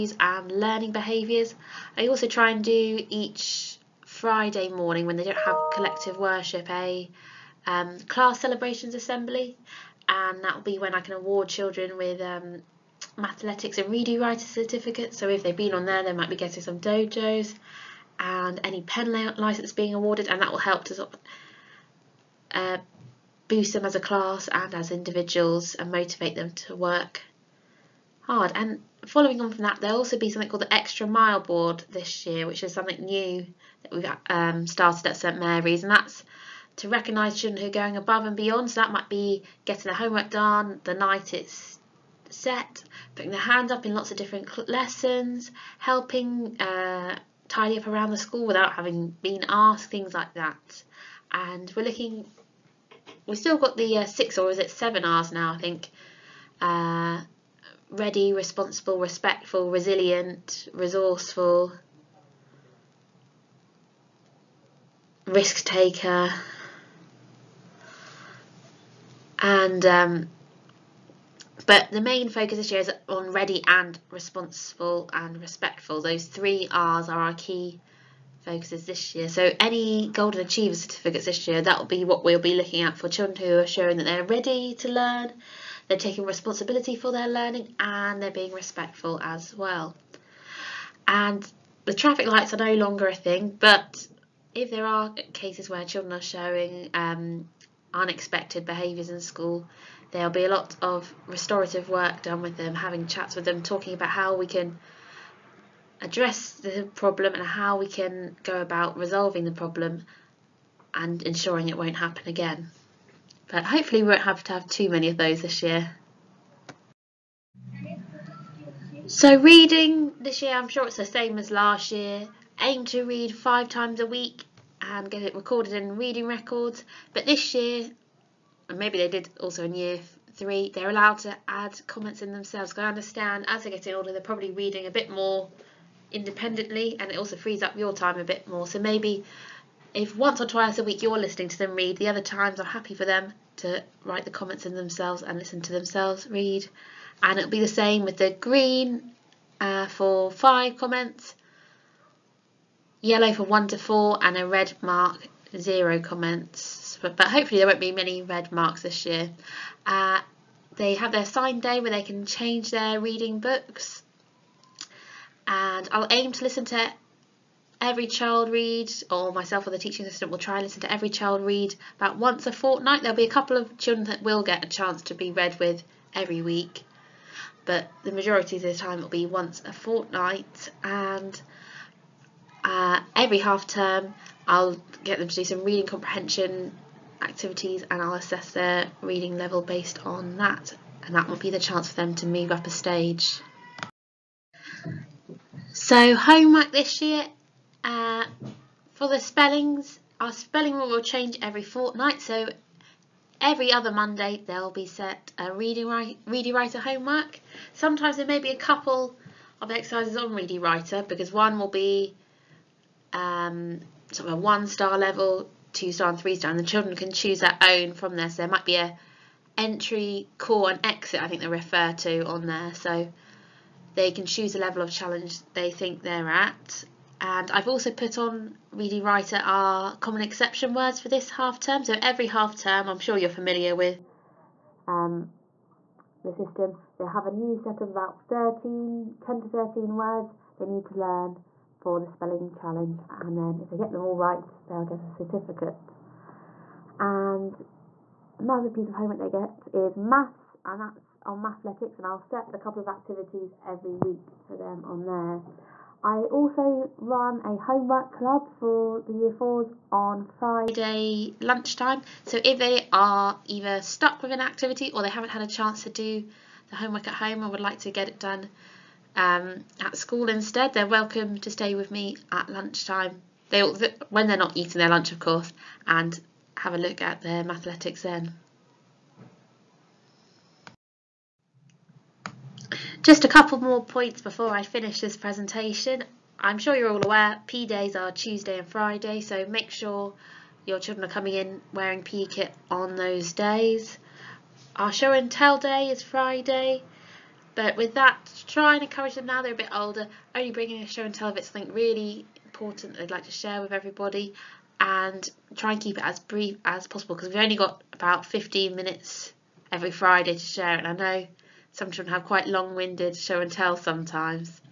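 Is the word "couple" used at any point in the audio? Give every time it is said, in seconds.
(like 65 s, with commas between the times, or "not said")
173 s, 208 s, 252 s, 283 s.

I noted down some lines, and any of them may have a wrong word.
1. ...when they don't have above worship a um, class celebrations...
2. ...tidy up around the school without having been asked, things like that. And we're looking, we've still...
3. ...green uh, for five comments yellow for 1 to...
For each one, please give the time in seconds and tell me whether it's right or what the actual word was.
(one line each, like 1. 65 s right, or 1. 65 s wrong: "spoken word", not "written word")
1. 5 s wrong: "collective", not "above"
2. 47 s right
3. 148 s right.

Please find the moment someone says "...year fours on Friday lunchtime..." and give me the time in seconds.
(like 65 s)
259 s.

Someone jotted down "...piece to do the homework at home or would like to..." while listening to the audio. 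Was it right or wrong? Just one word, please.
wrong.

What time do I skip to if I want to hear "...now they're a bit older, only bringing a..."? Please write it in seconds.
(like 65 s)
299 s.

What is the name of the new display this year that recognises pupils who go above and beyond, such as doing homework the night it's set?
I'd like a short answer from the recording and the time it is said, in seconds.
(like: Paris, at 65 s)
extra mile board, at 30 s.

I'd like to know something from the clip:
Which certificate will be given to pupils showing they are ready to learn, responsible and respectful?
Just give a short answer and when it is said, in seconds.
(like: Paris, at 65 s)
Golden Achiever, at 80 s.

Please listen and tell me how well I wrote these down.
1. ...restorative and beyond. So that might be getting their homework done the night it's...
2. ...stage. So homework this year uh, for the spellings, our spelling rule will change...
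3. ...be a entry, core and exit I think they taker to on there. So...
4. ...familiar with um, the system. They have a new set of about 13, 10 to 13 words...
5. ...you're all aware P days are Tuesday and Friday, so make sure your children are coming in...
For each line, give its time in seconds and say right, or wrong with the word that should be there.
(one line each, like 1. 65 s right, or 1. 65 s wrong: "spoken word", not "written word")
1. 37 s wrong: "above", not "restorative"
2. 192 s right
3. 218 s wrong: "refer", not "taker"
4. 233 s right
5. 286 s right.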